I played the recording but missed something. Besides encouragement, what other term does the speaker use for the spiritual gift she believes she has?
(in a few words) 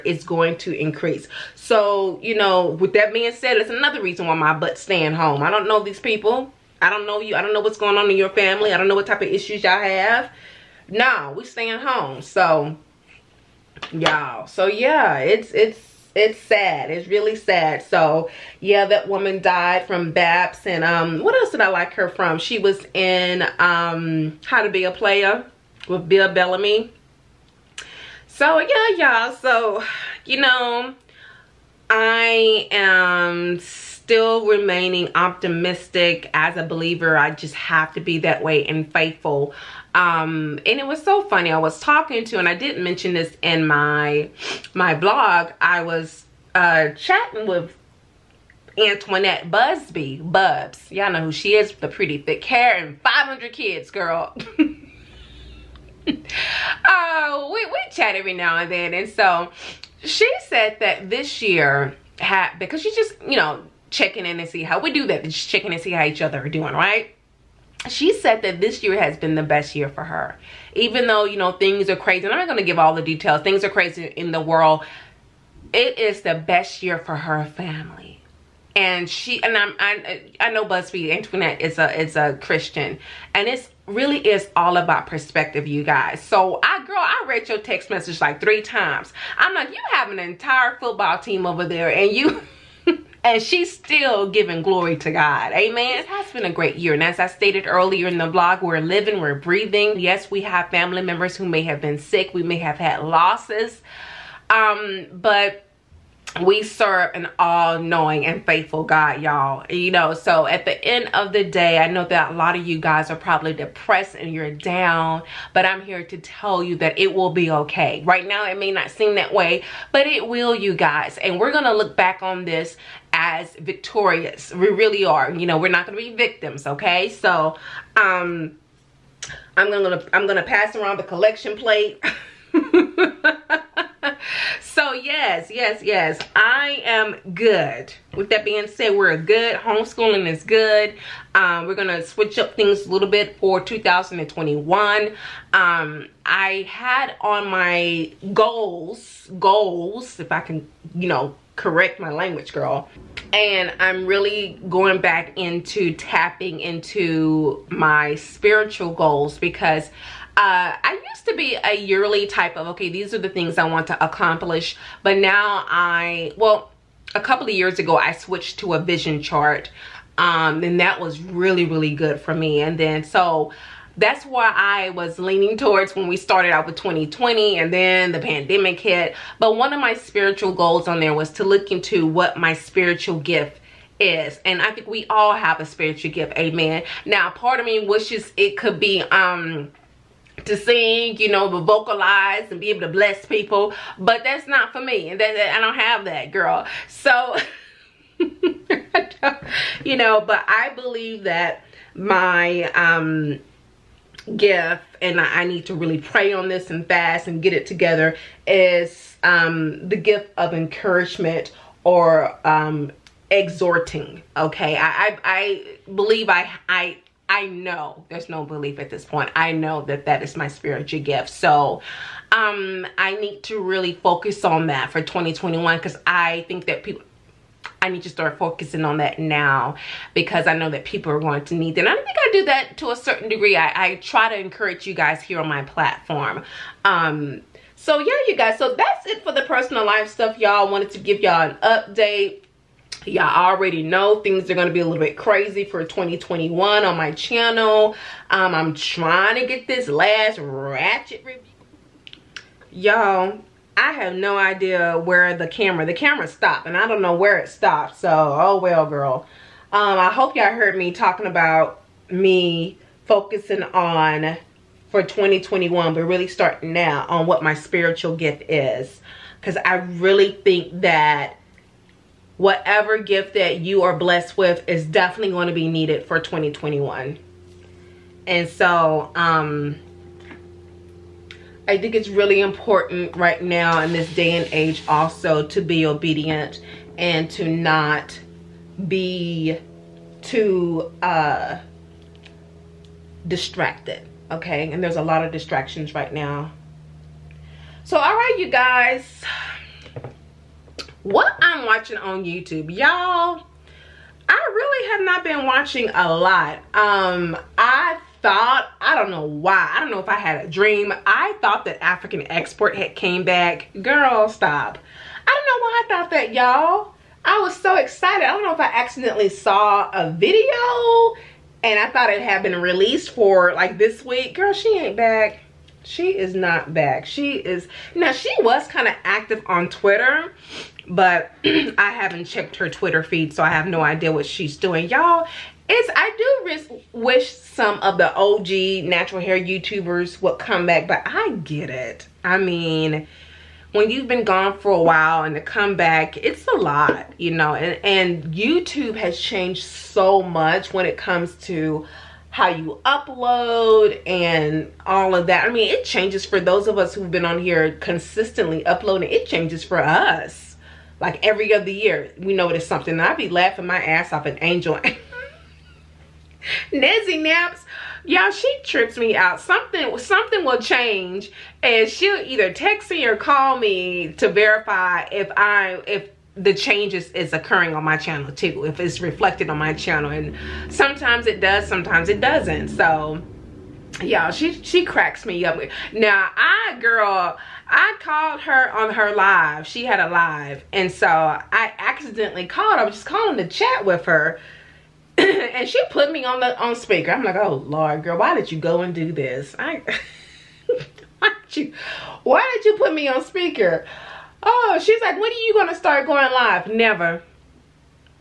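exhorting.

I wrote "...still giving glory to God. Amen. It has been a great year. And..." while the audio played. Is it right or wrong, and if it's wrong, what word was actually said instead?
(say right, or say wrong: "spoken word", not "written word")
right.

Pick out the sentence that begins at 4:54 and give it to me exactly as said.
And there's a lot of distractions right now.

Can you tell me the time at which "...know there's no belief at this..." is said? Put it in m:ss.
3:37.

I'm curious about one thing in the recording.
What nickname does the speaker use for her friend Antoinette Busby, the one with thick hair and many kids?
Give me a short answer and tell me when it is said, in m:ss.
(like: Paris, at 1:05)
Bubs, at 0:50.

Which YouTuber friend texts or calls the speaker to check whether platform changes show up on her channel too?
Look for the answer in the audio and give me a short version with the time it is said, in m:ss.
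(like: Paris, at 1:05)
Nezzy Naps, at 6:06.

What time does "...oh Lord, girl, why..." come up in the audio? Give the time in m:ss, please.
6:37.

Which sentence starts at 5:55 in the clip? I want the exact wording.
I mean, it changes for those of us who've been on here consistently uploading.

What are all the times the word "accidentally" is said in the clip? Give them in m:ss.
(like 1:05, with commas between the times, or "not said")
5:18, 6:31.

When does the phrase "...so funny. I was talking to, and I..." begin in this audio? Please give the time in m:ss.
0:41.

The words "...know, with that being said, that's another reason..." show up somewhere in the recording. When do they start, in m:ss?
0:02.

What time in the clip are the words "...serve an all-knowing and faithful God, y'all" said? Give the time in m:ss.
1:46.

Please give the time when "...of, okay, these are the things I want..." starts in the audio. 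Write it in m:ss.
2:42.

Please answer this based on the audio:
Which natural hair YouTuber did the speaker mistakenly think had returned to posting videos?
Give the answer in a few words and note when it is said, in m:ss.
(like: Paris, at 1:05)
African Export, at 5:11.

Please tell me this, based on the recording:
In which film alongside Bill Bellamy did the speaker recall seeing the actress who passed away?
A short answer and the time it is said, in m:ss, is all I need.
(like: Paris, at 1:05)
How to Be a Player, at 0:24.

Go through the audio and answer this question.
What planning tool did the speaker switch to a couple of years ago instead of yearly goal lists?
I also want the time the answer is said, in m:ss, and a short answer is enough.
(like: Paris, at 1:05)
vision chart, at 2:48.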